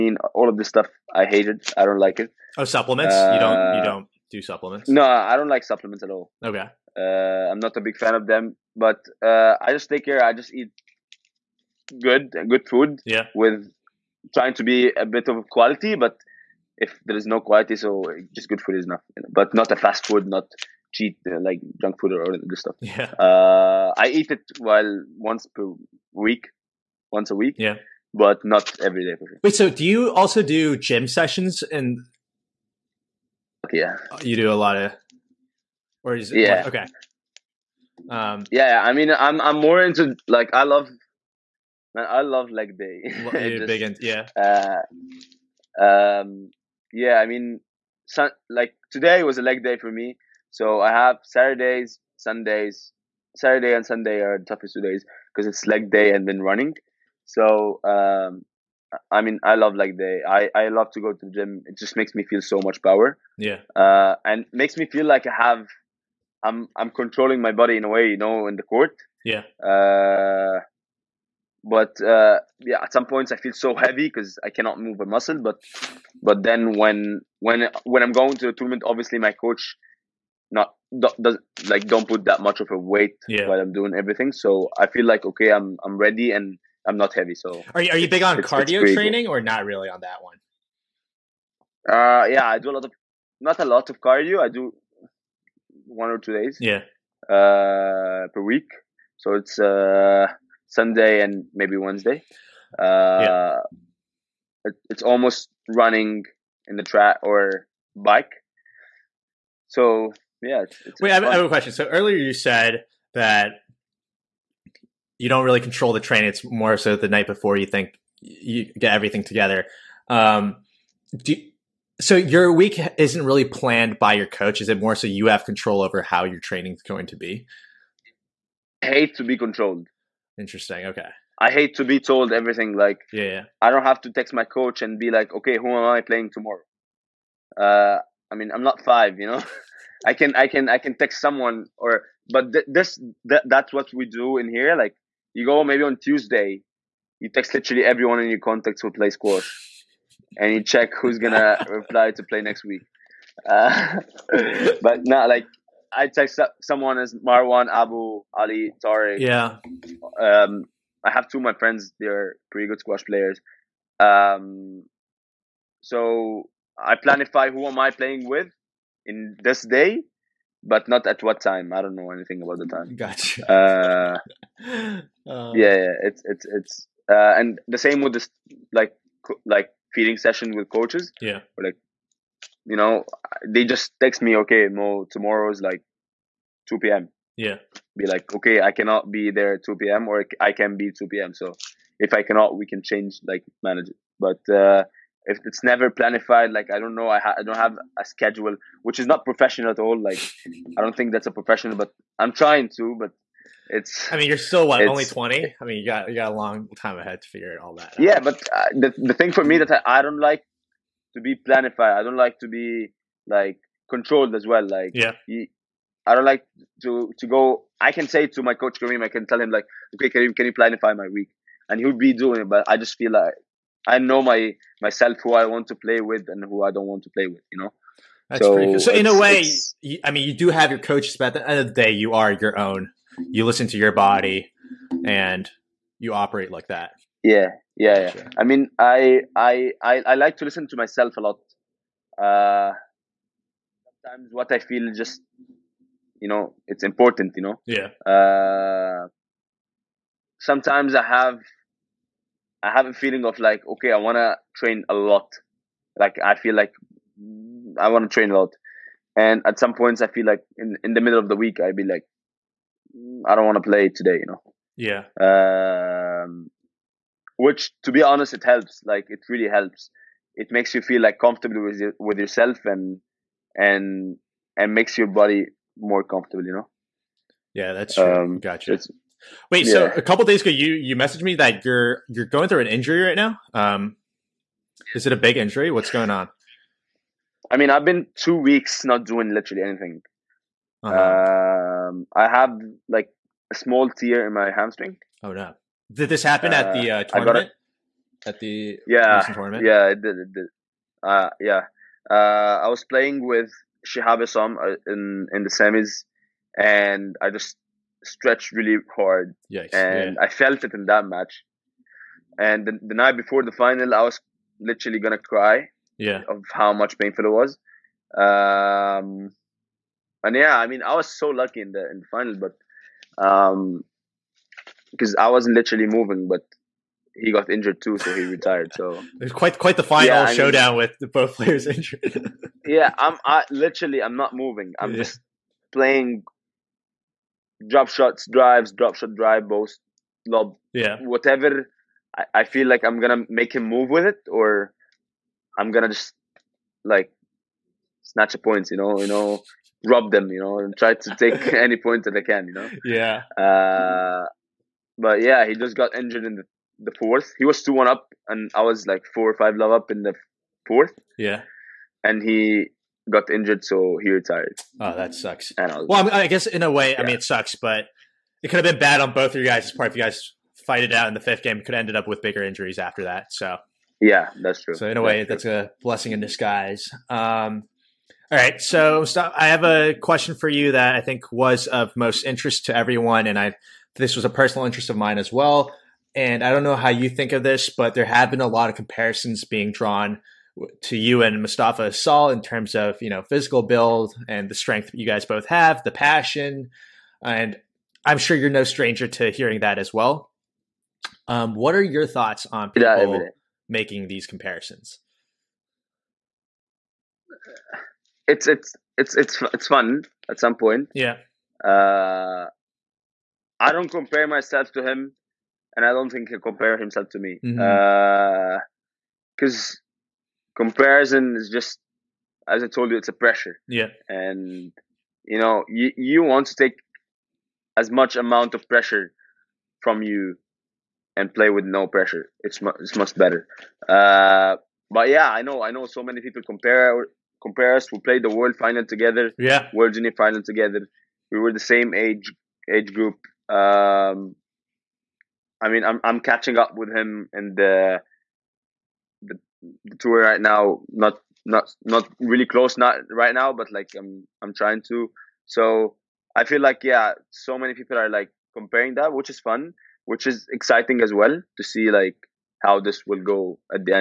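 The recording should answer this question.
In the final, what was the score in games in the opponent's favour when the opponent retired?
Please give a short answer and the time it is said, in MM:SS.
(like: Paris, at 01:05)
2-1, at 05:57.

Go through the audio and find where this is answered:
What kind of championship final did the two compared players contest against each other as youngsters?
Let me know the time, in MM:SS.
07:19.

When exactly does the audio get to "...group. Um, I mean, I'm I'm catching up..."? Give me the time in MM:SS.
07:22.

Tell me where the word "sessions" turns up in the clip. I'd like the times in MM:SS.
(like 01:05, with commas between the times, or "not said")
00:31, 03:00.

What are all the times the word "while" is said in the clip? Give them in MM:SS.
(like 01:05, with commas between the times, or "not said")
00:24, 01:23.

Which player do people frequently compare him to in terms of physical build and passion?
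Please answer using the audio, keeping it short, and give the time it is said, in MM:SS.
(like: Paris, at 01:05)
Mostafa Asal, at 06:31.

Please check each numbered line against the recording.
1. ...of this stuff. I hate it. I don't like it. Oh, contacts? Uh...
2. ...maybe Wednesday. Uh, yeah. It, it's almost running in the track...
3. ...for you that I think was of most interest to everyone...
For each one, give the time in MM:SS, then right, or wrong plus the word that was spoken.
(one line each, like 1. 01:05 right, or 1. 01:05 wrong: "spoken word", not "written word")
1. 00:00 wrong: "supplements", not "contacts"
2. 01:41 right
3. 06:20 right.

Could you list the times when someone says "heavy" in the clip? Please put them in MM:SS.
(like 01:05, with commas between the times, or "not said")
01:13, 01:27.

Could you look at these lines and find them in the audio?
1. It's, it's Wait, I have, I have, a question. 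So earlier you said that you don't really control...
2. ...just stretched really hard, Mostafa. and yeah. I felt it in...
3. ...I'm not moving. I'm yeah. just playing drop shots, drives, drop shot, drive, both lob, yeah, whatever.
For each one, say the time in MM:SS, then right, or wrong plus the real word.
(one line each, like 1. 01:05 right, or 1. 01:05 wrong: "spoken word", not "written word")
1. 01:50 right
2. 05:07 wrong: "Yikes", not "Mostafa"
3. 05:34 right.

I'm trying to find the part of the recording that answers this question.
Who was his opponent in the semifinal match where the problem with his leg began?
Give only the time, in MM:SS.
05:03.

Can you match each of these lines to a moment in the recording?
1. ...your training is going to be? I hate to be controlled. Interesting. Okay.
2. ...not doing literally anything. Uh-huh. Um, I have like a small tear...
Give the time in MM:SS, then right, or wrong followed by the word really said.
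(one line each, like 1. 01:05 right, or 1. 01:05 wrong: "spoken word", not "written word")
1. 02:06 right
2. 04:48 right.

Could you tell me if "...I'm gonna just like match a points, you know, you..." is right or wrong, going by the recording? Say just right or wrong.
wrong.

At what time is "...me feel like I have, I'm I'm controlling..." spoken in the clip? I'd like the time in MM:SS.
01:04.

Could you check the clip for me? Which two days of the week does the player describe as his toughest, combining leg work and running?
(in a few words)
Saturday and Sunday.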